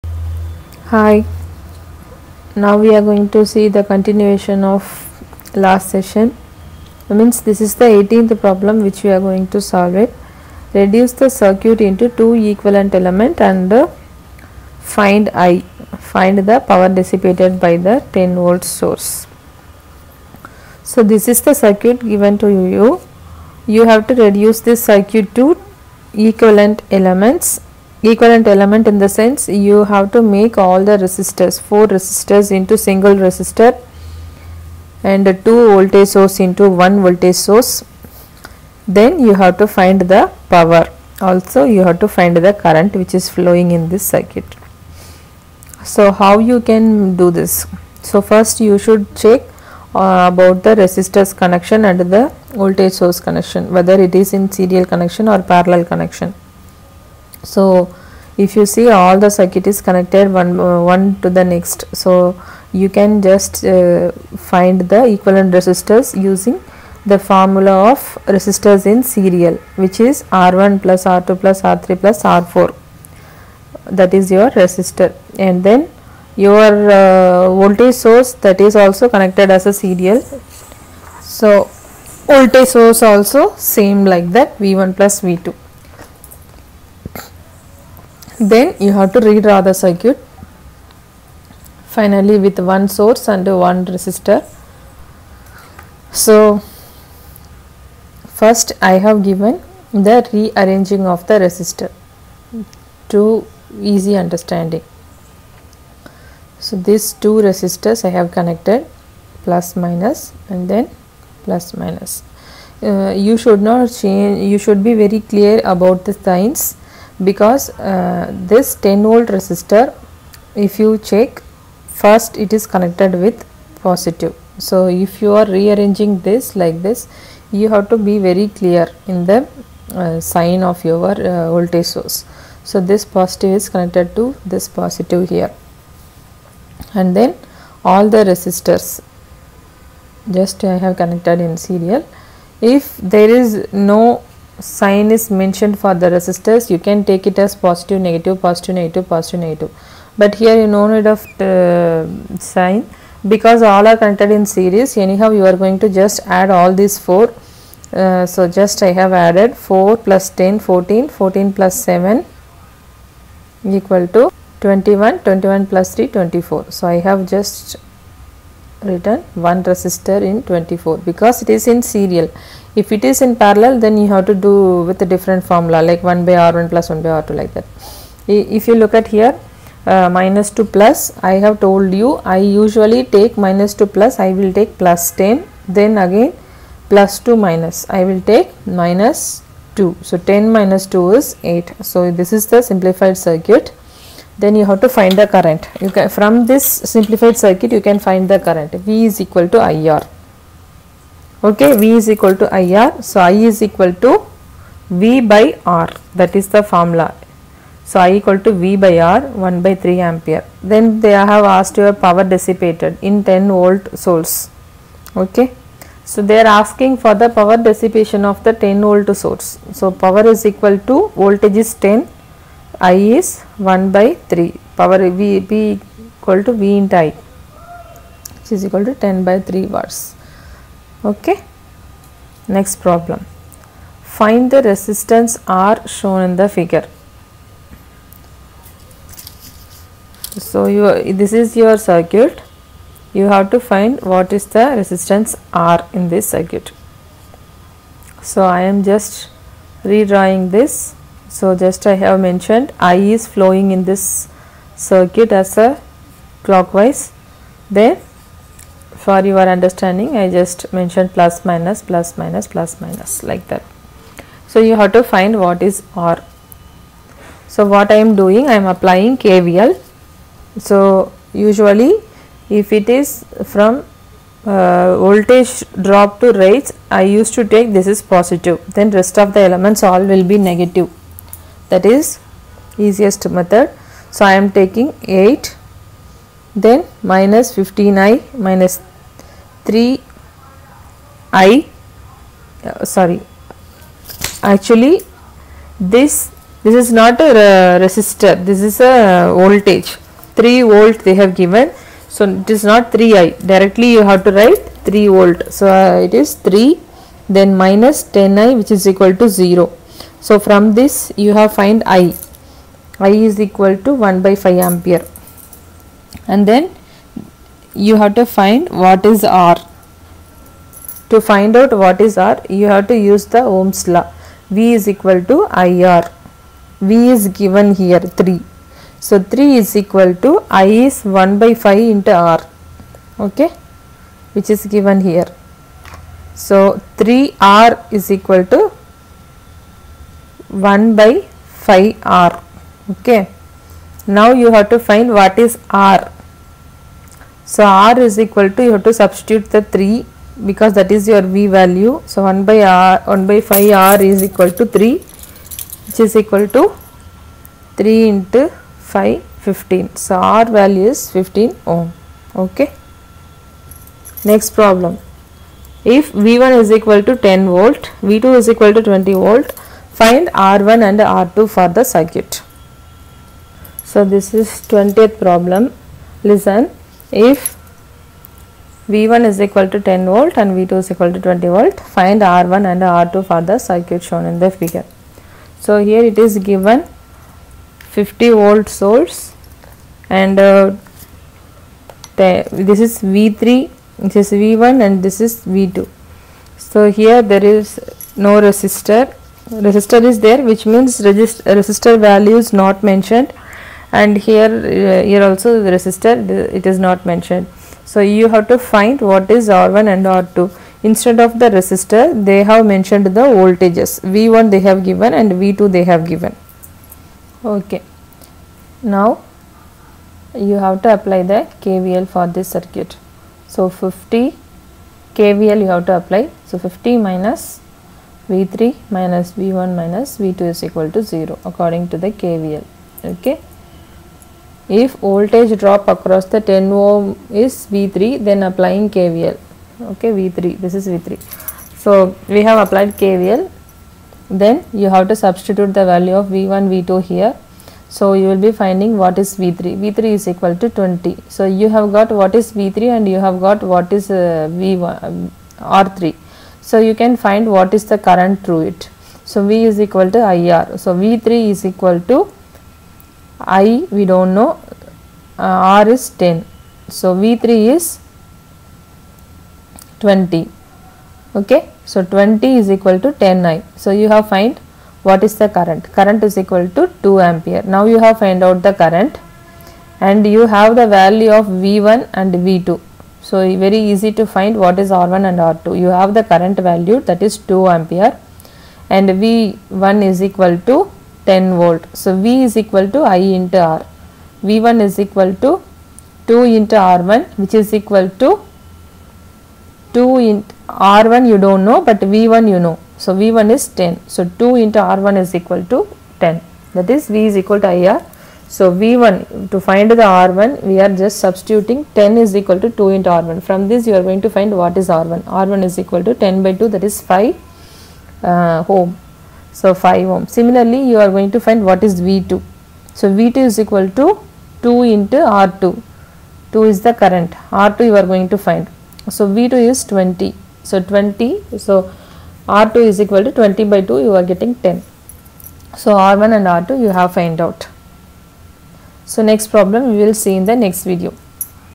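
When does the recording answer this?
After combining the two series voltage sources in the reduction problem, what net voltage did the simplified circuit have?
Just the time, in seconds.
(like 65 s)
190 s.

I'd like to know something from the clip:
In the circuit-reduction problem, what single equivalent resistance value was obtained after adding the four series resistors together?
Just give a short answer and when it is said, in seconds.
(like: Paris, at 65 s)
24, at 166 s.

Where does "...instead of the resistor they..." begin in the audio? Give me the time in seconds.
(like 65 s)
410 s.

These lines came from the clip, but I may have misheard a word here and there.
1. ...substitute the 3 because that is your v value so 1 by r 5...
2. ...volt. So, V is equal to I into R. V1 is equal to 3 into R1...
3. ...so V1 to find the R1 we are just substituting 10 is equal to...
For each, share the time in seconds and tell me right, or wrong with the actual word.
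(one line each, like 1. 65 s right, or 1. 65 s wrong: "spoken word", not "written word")
1. 348 s wrong: "1", not "5"
2. 491 s wrong: "2", not "3"
3. 508 s right.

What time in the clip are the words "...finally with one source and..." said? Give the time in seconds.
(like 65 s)
91 s.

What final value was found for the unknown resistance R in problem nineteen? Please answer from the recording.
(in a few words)
15 ohm.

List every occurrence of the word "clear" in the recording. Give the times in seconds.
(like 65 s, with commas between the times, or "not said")
115 s, 128 s.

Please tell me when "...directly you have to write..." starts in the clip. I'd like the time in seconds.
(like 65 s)
303 s.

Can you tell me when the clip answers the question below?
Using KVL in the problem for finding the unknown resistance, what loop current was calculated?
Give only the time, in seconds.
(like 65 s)
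312 s.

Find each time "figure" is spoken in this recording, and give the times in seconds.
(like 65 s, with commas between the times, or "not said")
236 s, 384 s.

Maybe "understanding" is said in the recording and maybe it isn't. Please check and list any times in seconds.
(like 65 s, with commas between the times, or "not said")
104 s, 259 s.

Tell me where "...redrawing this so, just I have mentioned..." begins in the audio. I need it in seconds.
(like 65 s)
249 s.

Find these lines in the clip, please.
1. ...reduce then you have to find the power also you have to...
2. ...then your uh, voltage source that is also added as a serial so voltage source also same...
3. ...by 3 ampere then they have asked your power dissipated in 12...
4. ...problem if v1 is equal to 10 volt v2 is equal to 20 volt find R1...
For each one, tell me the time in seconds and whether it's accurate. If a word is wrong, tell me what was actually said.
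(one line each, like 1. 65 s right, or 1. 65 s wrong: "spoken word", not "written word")
1. 37 s wrong: "source", not "reduce"
2. 75 s wrong: "connected", not "added"
3. 209 s wrong: "10", not "12"
4. 364 s right.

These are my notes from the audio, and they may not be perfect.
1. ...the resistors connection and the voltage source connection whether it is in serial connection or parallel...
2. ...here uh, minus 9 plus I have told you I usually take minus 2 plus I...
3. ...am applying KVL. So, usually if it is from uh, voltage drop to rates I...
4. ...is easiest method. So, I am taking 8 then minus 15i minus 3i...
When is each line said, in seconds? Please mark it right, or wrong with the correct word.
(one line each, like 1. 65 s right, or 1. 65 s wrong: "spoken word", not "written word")
1. 50 s right
2. 179 s wrong: "2", not "9"
3. 268 s right
4. 281 s right.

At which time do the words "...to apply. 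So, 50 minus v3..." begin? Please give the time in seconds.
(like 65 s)
425 s.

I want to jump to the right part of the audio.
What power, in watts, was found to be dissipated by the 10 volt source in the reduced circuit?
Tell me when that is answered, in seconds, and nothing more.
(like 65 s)
229 s.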